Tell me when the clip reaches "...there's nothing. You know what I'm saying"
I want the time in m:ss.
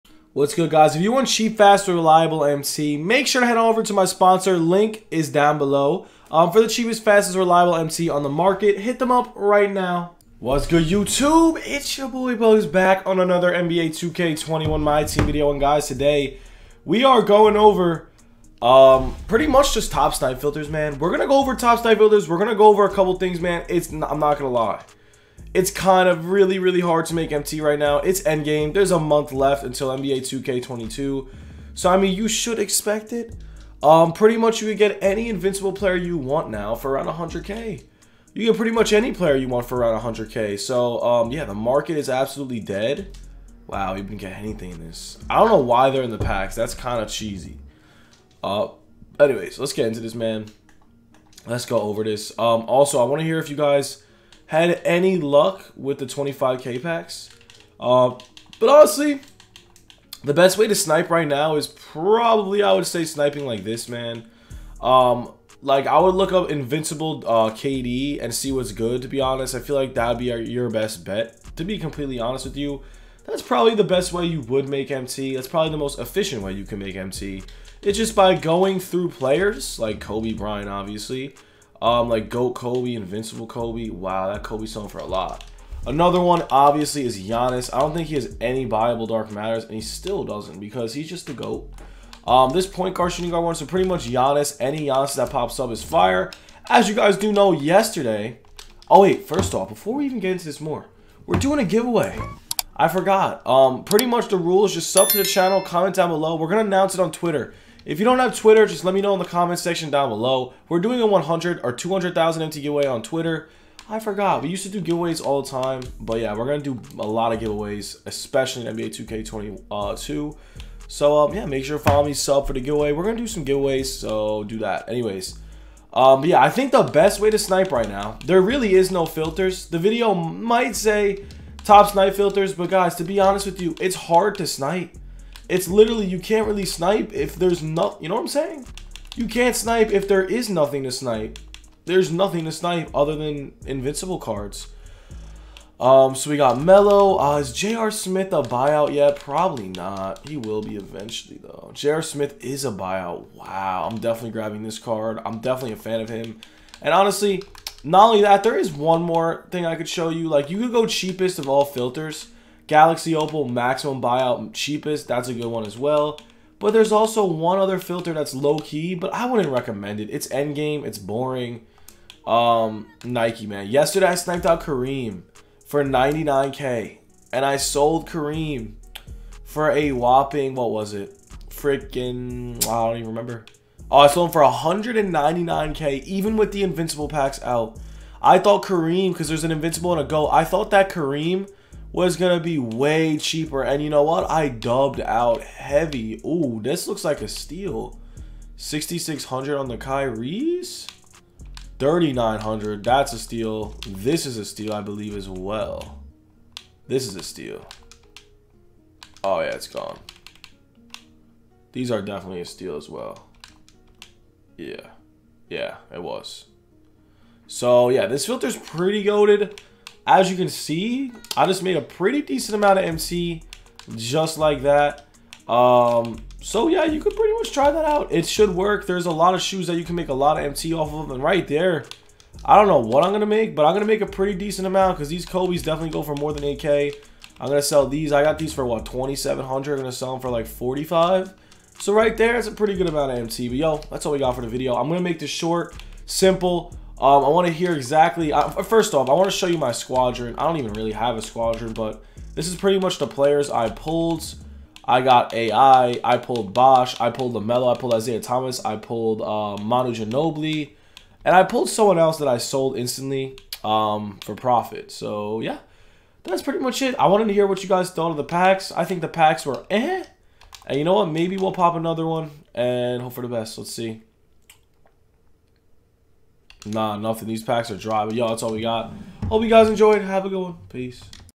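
2:17.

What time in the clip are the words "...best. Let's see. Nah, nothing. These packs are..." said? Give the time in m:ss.
4:33.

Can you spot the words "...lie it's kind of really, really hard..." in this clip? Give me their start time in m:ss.
0:24.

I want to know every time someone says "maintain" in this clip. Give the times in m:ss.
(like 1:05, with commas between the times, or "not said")
not said.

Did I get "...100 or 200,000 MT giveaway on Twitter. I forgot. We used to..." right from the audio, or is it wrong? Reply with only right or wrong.
right.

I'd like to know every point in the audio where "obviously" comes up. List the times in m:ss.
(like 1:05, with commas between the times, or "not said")
1:20, 1:26.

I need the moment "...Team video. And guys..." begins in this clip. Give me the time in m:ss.
0:15.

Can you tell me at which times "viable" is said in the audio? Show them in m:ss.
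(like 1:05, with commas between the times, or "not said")
1:28.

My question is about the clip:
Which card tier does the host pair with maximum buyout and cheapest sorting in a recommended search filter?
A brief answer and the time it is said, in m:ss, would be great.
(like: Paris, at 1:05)
Galaxy Opal, at 2:42.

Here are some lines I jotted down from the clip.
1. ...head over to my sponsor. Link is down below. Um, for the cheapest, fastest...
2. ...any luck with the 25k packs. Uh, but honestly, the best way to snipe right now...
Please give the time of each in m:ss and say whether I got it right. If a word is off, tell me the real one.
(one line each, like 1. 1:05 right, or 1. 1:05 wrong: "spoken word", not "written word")
1. 0:03 right
2. 0:54 right.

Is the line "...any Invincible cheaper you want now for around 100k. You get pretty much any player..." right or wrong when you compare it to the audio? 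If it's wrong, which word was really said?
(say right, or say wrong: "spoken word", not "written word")
wrong: "player", not "cheaper".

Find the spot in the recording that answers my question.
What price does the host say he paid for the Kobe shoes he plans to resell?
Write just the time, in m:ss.
3:58.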